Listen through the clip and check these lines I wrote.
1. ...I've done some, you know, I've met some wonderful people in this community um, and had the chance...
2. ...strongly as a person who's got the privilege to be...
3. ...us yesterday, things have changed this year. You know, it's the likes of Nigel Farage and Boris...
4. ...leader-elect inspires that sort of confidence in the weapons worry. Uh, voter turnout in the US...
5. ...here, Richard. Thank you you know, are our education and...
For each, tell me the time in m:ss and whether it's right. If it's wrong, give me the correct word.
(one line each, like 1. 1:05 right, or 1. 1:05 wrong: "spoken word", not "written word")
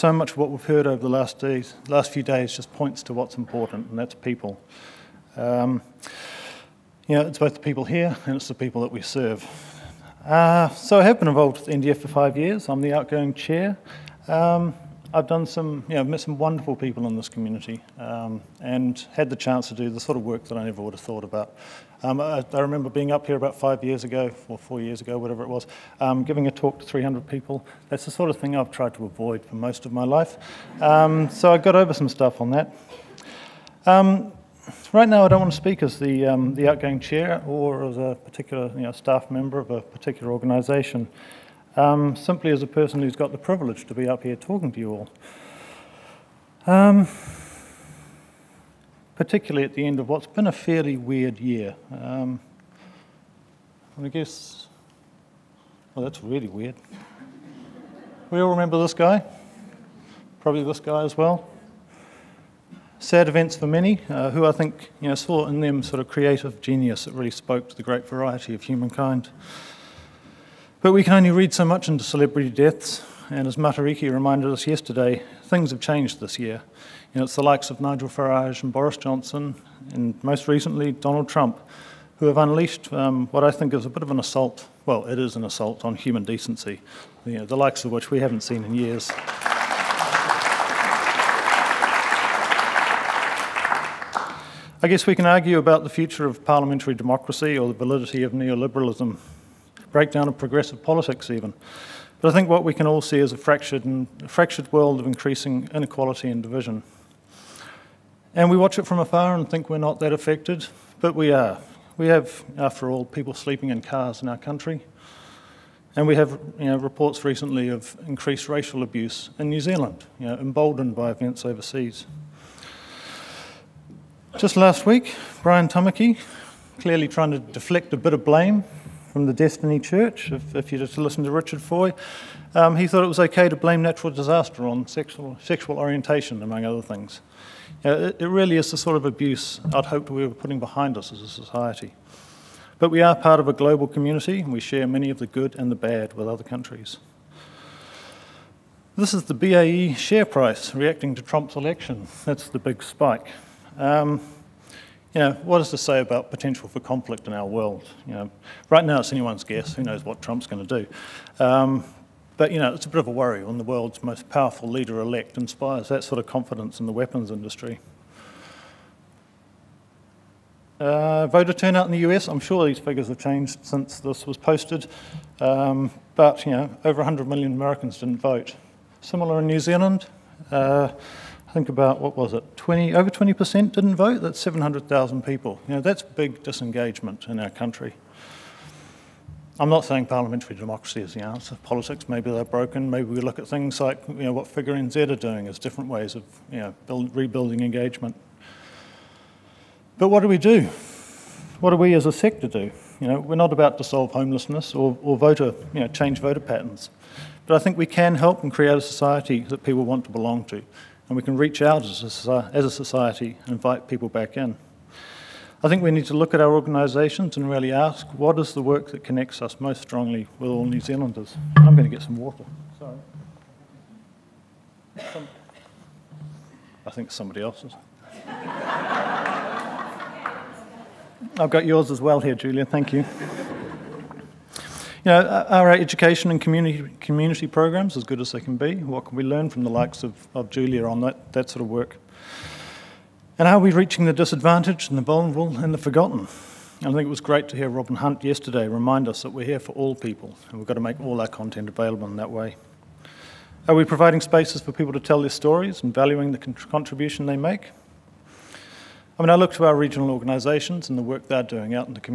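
1. 0:15 right
2. 0:42 wrong: "simply", not "strongly"
3. 1:14 right
4. 2:44 wrong: "industry", not "worry"
5. 3:52 wrong: "Julia", not "Richard".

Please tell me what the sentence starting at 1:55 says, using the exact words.
And we have you know, reports recently of increased racial abuse in New Zealand, you know, emboldened by events overseas.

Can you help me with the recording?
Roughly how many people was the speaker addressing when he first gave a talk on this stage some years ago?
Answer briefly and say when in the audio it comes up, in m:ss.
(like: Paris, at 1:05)
300, at 0:26.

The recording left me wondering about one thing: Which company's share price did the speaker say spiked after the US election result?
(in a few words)
BAE.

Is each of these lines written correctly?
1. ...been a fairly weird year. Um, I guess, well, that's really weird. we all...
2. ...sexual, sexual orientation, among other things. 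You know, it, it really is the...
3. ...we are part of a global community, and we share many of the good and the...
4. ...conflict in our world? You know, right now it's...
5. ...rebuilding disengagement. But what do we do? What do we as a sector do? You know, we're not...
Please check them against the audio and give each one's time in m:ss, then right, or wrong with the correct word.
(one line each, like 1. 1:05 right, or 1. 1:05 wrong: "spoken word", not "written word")
1. 0:50 right
2. 2:14 right
3. 2:22 right
4. 2:36 right
5. 3:17 wrong: "engagement", not "disengagement".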